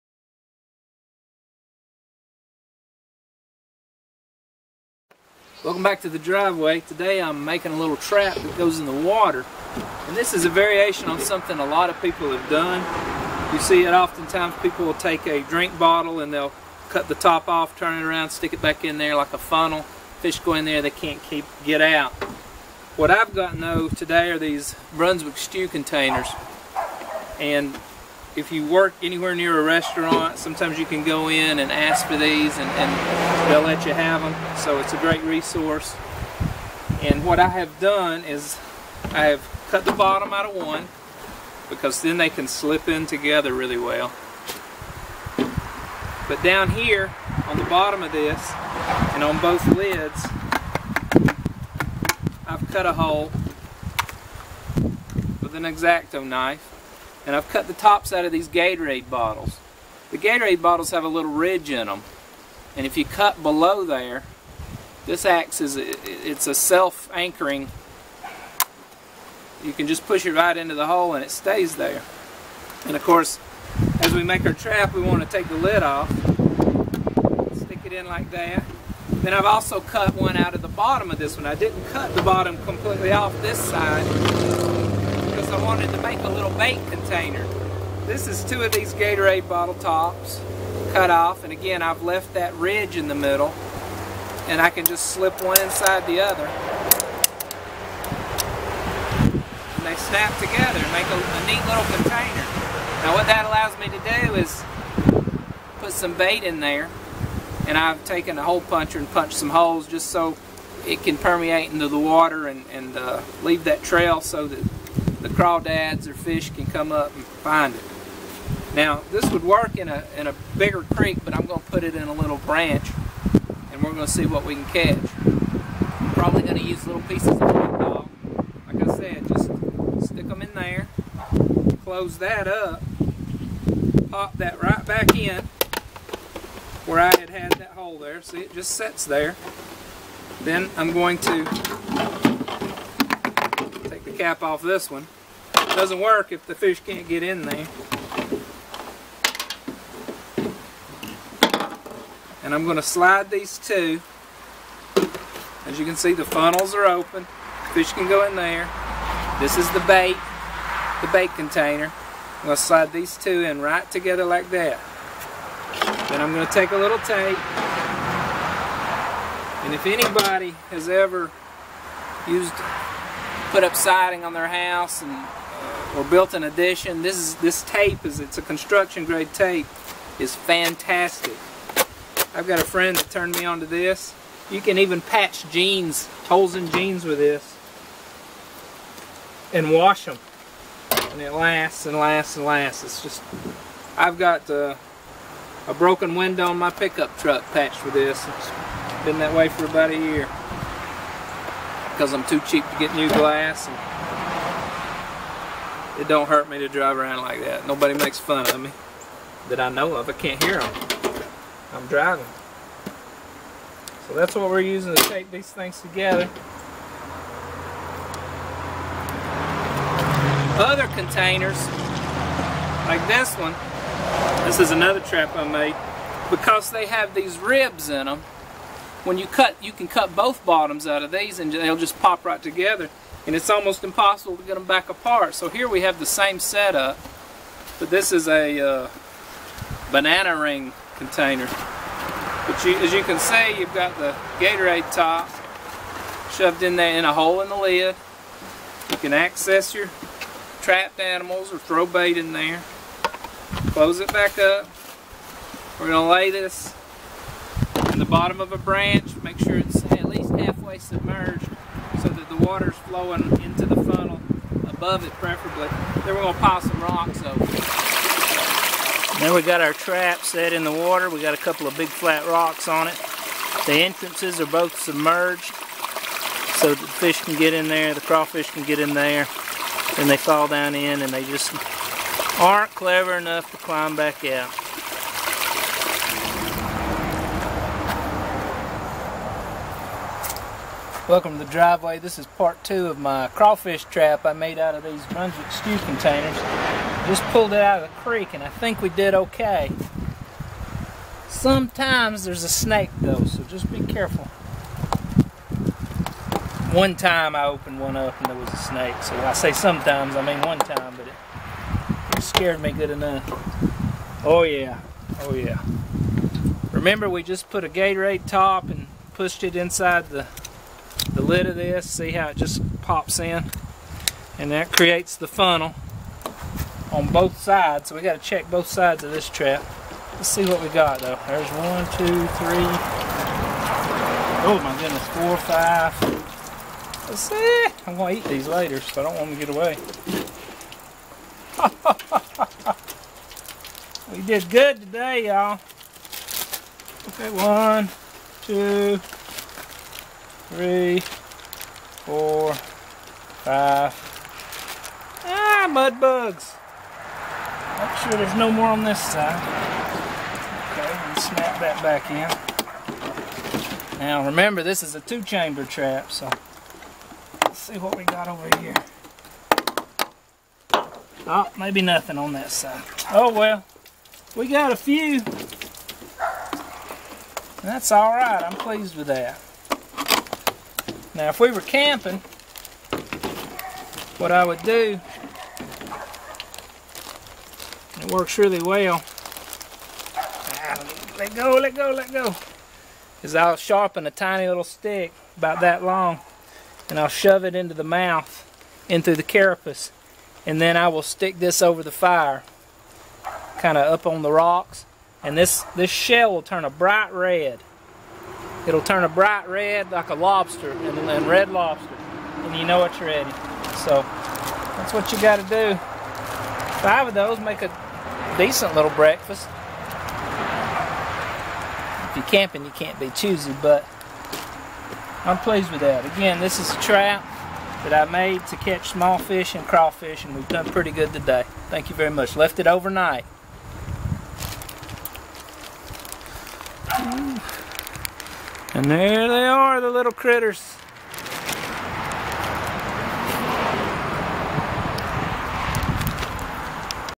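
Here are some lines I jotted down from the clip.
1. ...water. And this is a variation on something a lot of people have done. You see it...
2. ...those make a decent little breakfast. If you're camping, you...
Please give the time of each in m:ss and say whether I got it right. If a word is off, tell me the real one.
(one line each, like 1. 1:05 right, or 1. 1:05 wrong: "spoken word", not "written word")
1. 0:09 right
2. 6:57 right.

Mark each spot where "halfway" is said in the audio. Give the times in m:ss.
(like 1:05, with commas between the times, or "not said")
4:20.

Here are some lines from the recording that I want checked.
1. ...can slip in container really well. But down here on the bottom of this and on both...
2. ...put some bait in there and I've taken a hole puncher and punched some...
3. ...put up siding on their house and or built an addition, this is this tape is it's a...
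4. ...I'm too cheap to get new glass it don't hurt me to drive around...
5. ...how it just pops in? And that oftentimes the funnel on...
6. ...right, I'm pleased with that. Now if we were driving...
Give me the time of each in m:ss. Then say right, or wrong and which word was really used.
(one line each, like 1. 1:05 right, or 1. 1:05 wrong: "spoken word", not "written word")
1. 0:42 wrong: "together", not "container"
2. 1:45 right
3. 2:53 right
4. 3:22 right
5. 5:22 wrong: "creates", not "oftentimes"
6. 6:18 wrong: "camping", not "driving".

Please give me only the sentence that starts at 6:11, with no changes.
Oh, maybe nothing on that side.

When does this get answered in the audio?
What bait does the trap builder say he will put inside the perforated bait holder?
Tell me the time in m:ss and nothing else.
2:07.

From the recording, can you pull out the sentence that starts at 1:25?
I wanted to make a little bait container.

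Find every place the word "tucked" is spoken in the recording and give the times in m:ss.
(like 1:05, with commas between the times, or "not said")
not said.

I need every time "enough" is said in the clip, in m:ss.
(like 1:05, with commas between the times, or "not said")
4:43, 5:12.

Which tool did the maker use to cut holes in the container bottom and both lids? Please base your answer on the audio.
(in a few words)
X-Acto knife.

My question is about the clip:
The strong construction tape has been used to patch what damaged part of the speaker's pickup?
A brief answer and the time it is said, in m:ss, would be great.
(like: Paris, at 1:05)
a broken window, at 3:15.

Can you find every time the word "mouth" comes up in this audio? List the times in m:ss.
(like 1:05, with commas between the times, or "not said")
6:37.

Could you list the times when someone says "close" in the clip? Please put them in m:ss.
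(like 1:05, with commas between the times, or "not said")
2:11, 4:13.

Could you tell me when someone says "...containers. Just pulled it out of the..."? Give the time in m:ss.
4:55.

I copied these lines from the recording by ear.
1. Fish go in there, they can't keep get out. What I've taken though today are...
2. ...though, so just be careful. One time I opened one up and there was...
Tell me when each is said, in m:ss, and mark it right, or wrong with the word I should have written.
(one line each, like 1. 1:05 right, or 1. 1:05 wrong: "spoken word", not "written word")
1. 0:20 wrong: "gotten", not "taken"
2. 5:03 right.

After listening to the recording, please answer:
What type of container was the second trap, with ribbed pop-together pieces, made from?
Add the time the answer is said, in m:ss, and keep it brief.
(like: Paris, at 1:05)
banana ring container, at 3:59.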